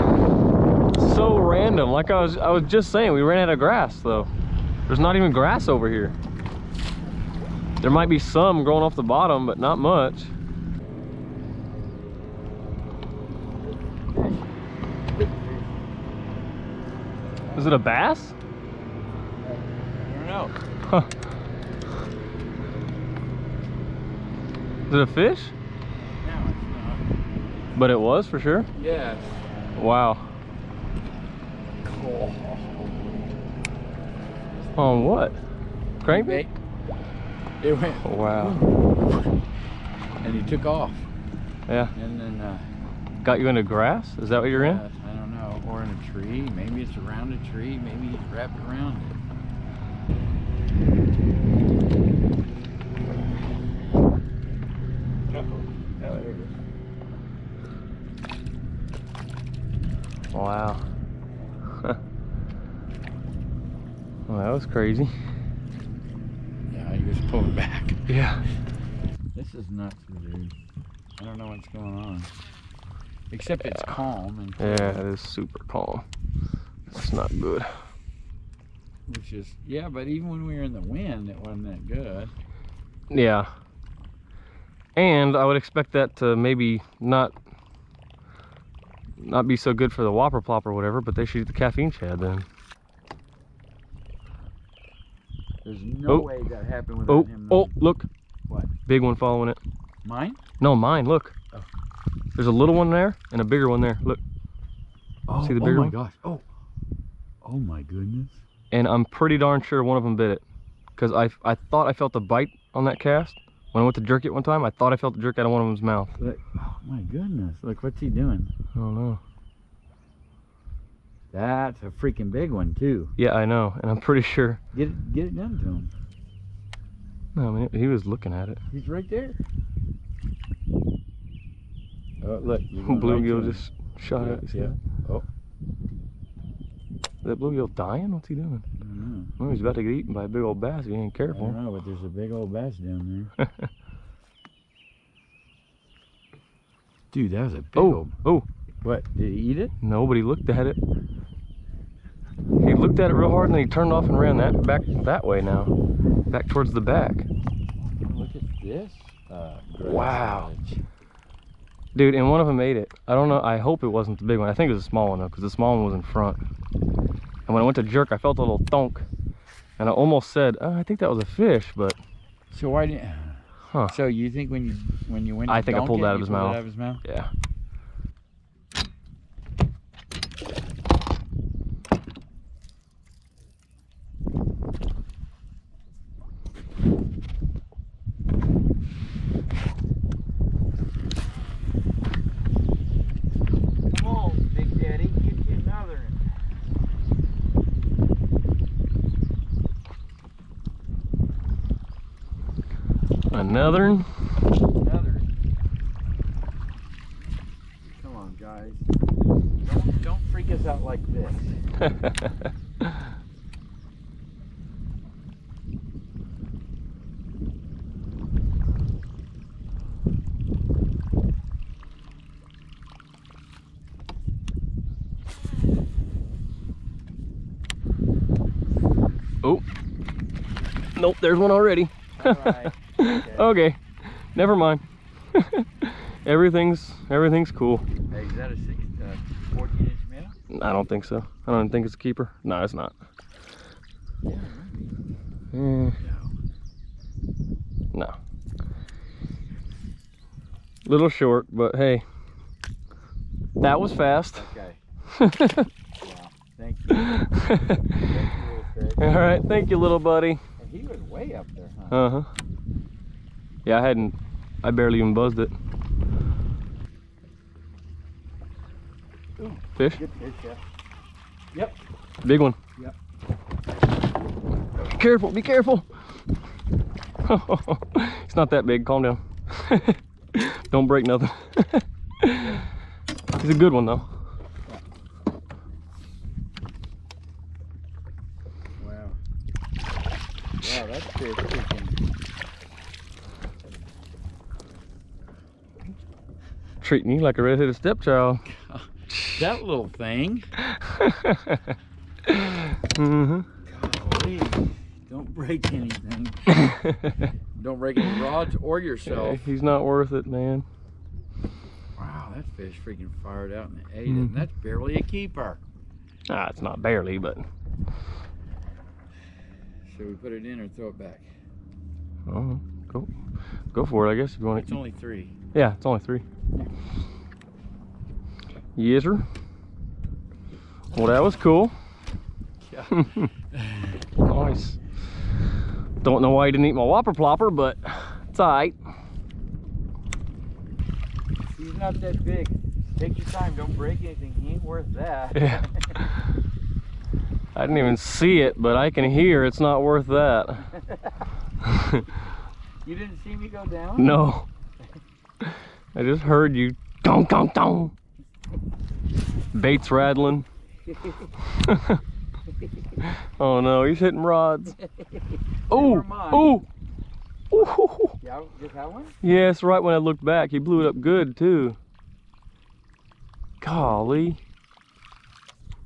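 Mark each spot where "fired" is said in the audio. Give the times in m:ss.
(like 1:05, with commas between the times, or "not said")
5:13.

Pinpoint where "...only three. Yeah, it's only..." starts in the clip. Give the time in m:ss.
5:24.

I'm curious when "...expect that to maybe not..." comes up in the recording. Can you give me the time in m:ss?
1:25.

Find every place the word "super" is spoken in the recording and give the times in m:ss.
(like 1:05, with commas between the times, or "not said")
1:15.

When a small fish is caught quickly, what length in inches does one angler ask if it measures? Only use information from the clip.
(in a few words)
14.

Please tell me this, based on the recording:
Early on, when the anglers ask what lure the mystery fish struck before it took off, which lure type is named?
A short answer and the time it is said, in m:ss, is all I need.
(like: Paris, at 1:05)
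Crankbait, at 0:35.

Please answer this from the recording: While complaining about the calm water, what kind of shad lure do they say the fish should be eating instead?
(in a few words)
caffeine shad.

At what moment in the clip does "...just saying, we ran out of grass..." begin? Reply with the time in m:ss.
0:02.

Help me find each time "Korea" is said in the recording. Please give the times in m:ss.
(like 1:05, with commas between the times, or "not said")
not said.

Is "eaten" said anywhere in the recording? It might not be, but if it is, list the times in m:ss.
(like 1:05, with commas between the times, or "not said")
2:19.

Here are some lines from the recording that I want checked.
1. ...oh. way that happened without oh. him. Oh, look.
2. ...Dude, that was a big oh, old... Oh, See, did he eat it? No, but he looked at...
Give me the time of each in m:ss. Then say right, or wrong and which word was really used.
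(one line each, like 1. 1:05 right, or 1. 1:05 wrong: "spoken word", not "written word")
1. 1:36 right
2. 2:27 wrong: "What", not "See".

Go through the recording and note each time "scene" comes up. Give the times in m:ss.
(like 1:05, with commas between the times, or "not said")
not said.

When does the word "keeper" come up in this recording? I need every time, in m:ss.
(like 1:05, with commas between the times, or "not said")
4:01, 5:15.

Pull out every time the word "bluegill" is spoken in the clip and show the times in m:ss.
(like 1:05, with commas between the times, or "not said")
2:12, 2:17.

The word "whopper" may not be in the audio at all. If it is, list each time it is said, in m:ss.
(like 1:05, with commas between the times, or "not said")
1:30, 5:36.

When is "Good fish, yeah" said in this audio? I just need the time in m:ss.
4:29.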